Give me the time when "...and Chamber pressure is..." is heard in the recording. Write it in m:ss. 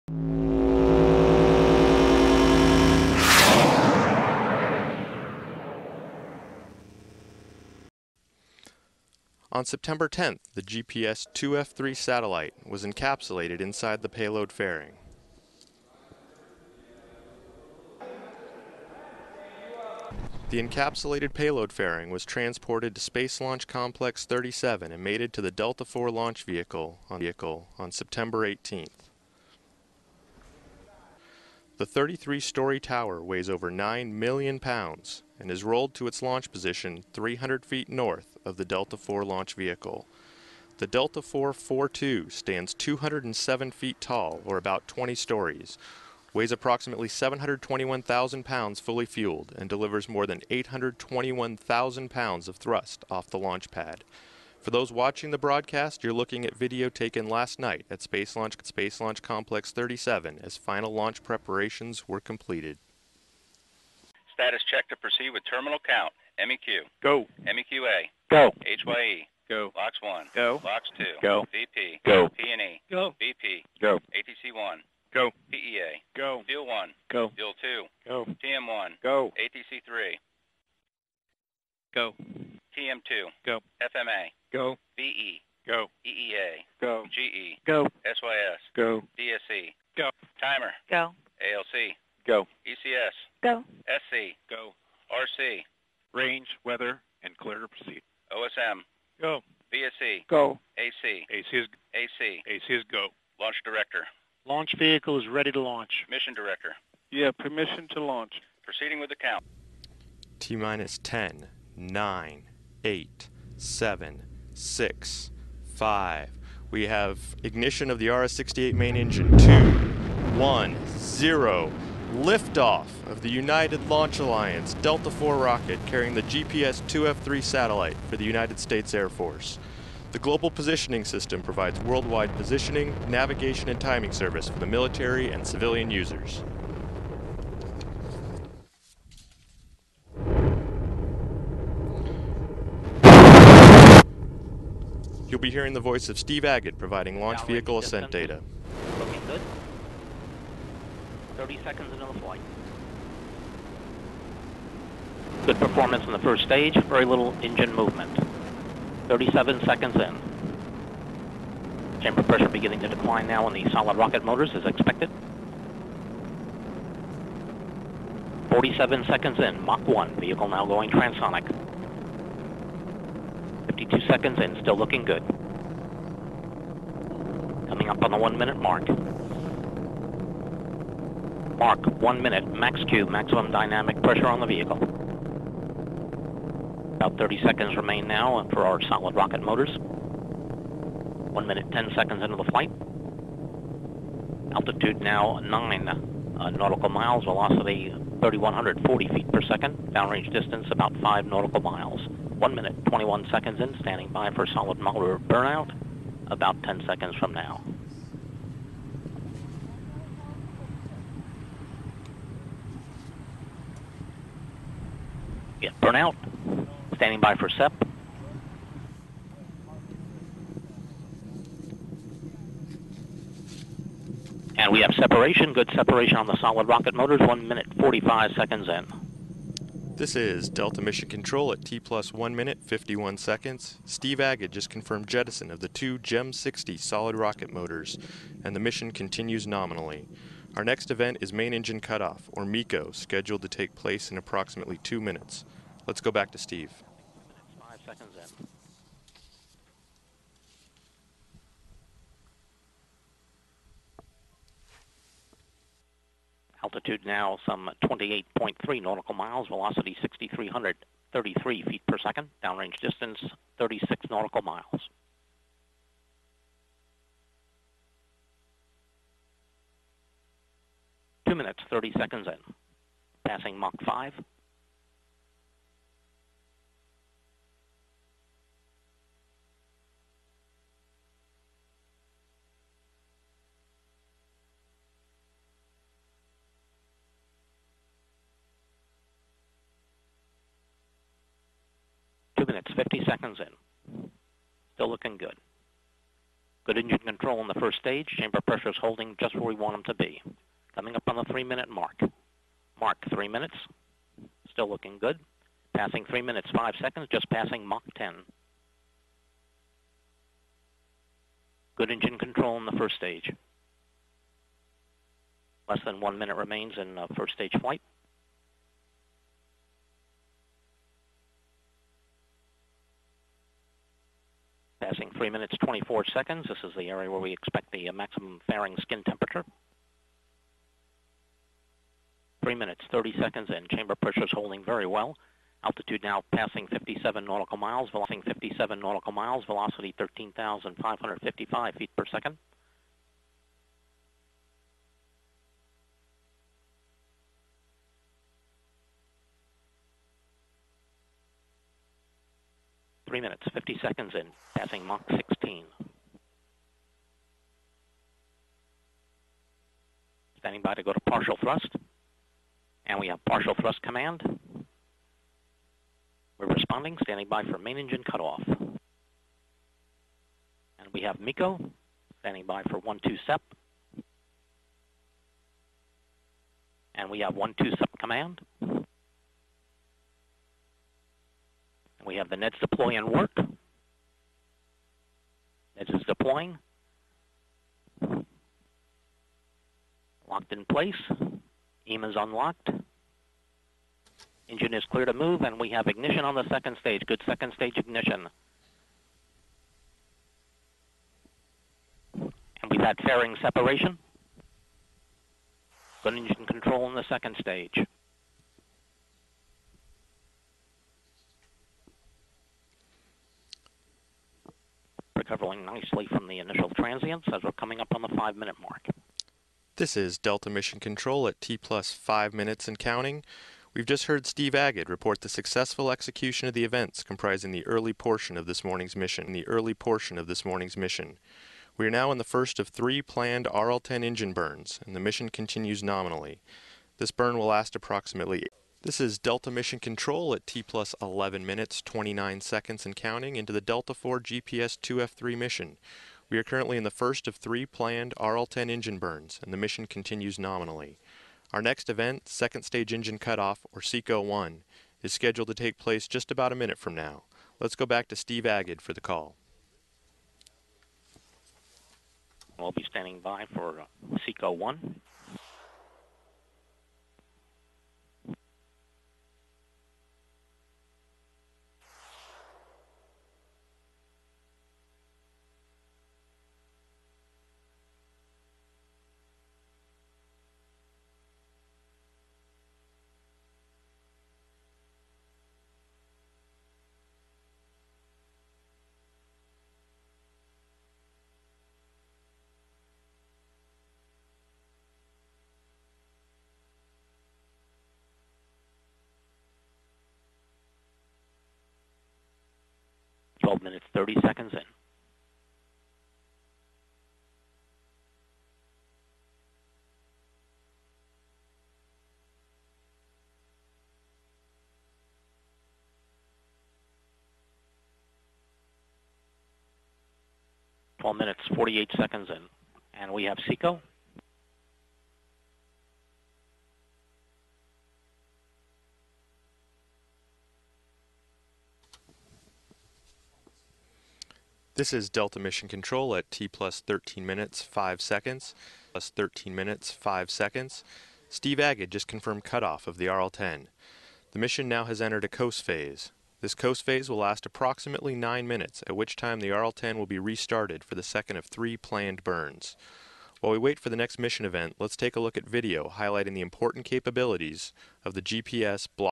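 5:33.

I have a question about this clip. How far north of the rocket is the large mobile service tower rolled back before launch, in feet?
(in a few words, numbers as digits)
300 feet.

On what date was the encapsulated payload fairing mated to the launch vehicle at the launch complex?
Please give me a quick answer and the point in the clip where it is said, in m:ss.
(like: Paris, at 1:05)
September 18th, at 0:27.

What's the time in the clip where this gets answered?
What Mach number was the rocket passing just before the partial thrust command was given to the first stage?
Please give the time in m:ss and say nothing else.
5:54.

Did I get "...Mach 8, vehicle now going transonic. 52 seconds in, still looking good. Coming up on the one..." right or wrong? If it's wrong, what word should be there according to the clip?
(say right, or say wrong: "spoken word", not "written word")
wrong: "1", not "8".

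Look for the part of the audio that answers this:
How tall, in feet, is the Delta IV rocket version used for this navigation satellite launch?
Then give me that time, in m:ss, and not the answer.
0:42.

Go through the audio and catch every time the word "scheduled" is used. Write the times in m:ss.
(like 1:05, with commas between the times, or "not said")
4:02, 7:35.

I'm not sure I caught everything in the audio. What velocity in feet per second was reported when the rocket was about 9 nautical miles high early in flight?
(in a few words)
3,140 feet per second.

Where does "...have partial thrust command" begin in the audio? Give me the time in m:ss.
6:03.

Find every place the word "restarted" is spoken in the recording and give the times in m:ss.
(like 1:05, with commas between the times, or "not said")
9:10.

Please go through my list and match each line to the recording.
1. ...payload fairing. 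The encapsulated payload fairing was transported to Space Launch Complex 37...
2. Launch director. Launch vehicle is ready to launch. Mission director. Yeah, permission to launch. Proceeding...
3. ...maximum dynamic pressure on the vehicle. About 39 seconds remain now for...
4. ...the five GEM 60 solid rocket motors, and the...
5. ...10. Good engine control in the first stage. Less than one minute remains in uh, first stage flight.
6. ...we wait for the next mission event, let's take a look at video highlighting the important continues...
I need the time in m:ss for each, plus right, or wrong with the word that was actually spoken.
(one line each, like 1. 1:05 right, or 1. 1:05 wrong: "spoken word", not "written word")
1. 0:14 right
2. 1:43 right
3. 3:03 wrong: "30", not "39"
4. 3:55 wrong: "two", not "five"
5. 5:07 right
6. 9:13 wrong: "capabilities", not "continues".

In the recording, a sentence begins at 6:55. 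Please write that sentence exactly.
Recovering nicely from the initial transients as we're coming up on the five-minute mark.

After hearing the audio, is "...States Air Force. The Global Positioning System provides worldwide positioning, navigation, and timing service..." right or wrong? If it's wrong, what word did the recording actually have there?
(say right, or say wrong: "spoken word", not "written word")
right.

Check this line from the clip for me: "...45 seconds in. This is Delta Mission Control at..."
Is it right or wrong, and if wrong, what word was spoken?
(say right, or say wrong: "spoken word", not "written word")
right.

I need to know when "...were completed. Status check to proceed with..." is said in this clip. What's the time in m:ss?
1:02.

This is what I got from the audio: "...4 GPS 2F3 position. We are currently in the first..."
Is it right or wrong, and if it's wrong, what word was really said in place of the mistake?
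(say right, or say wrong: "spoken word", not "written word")
wrong: "mission", not "position".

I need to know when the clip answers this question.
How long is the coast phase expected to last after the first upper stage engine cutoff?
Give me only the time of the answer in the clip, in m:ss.
9:08.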